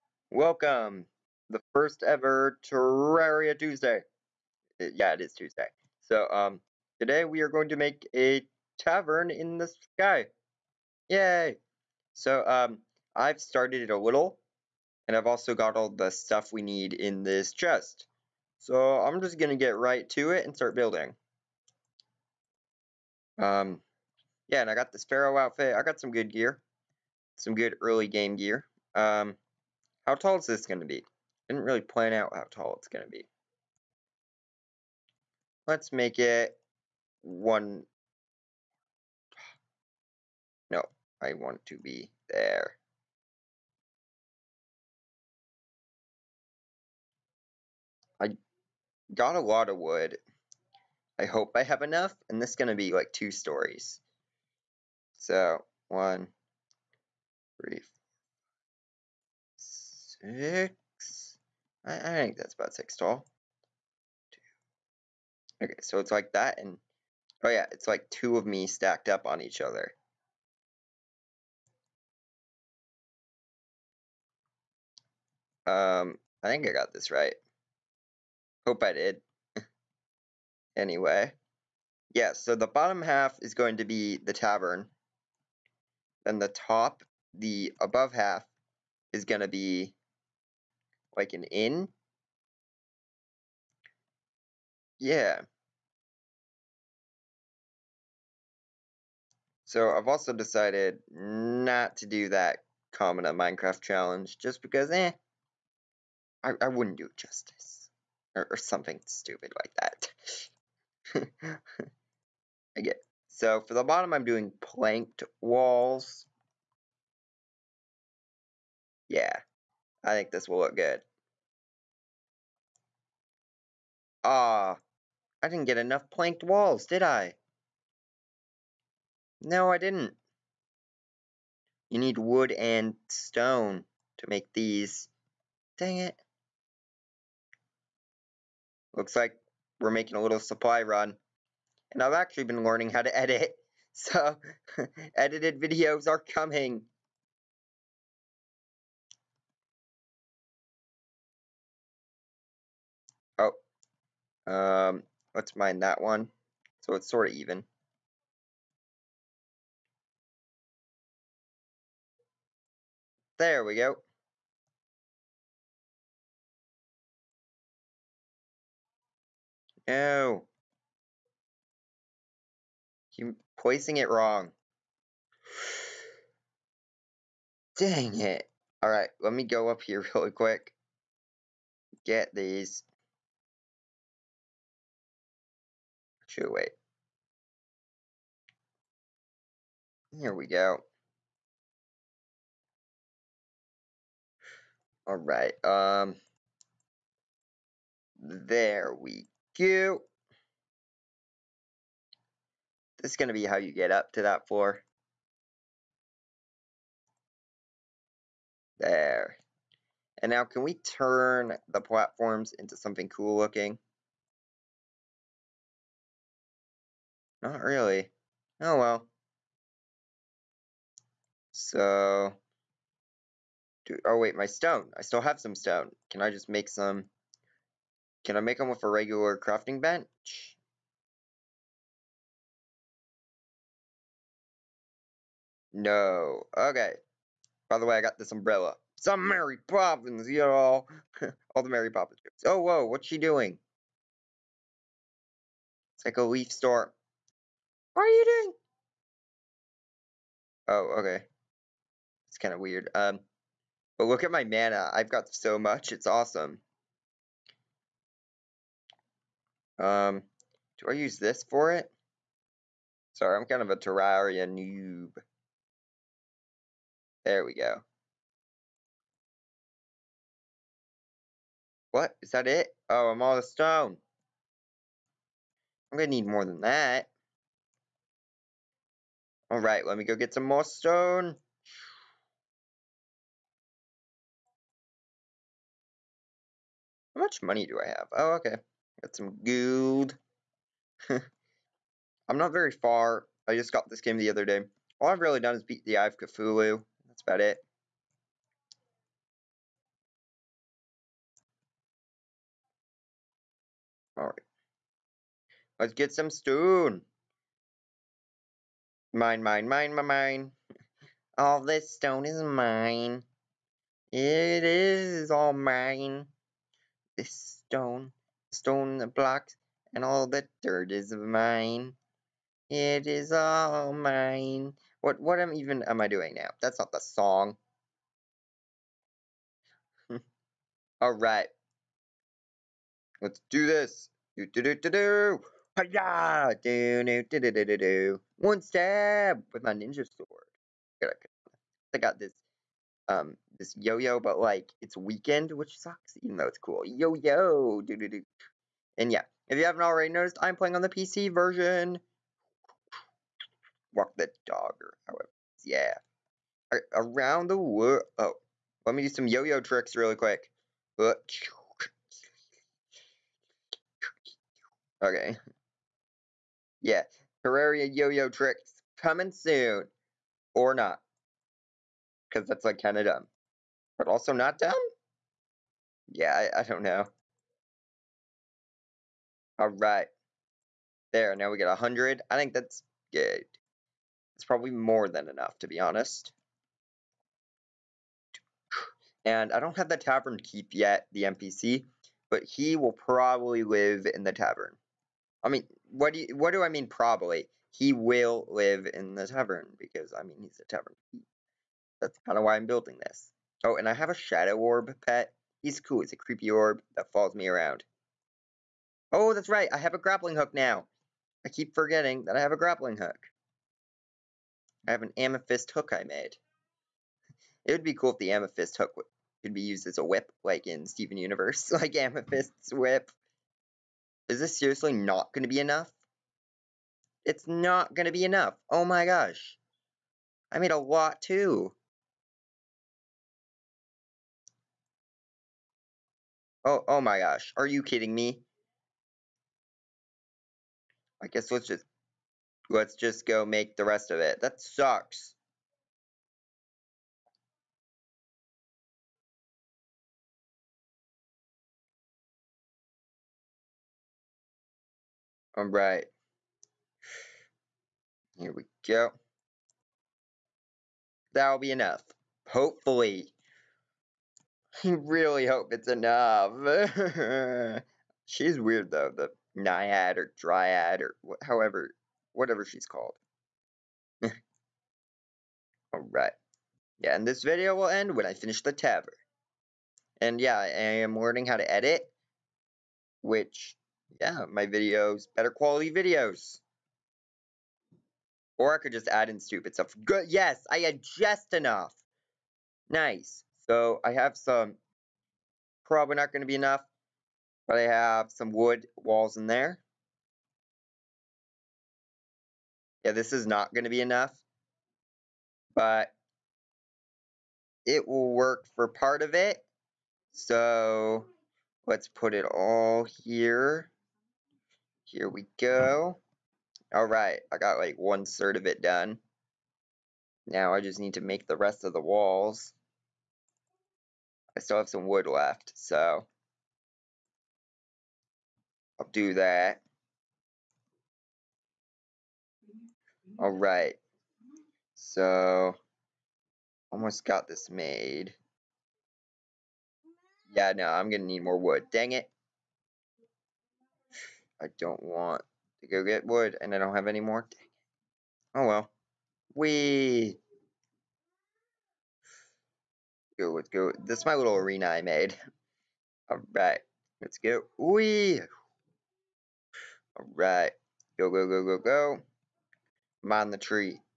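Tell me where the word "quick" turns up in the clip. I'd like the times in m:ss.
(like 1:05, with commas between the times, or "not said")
3:00, 6:00.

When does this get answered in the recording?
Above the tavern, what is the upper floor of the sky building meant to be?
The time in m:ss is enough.
1:31.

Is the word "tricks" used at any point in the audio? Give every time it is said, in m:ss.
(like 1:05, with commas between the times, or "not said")
5:59, 6:08.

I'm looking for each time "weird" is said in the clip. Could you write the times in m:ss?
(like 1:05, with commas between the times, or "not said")
4:12, 7:48.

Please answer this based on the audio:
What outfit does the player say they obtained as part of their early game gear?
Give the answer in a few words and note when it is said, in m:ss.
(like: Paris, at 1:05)
Pharaoh outfit, at 0:25.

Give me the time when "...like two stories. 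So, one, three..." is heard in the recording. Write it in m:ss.
0:52.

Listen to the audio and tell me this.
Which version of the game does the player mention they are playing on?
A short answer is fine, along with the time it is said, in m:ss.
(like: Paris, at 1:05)
PC, at 5:50.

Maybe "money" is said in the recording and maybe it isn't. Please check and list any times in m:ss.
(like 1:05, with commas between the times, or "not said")
4:47.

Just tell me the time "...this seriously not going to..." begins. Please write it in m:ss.
7:04.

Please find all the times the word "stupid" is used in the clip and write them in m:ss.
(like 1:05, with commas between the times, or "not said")
1:49, 8:09.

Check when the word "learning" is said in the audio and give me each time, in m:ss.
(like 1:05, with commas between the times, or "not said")
2:22, 8:01.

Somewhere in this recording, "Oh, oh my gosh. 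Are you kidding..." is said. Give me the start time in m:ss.
7:16.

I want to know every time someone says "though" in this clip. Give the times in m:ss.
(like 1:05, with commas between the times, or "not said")
5:46, 7:48.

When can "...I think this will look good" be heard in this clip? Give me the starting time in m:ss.
2:00.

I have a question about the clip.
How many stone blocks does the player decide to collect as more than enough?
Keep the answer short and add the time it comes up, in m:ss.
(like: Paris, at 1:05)
100, at 6:21.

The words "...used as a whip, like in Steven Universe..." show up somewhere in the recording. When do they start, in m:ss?
6:59.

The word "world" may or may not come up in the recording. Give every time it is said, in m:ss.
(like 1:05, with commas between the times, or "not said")
5:57.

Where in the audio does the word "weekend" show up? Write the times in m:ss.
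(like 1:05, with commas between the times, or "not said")
5:44.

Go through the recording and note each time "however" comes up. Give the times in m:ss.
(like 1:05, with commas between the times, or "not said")
5:55, 7:51.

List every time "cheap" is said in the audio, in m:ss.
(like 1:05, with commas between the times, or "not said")
not said.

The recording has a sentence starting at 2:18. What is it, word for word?
Looks like we're making a little supply run.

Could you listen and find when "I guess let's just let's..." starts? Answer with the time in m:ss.
7:21.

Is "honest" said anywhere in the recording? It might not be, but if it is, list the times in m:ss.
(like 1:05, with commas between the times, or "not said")
6:25.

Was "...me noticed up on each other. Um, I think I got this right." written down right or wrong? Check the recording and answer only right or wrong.
wrong.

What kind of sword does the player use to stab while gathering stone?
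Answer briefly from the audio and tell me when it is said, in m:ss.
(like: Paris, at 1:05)
ninja sword, at 5:39.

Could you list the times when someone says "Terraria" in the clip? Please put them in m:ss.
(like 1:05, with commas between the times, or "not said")
0:02, 4:23, 6:07.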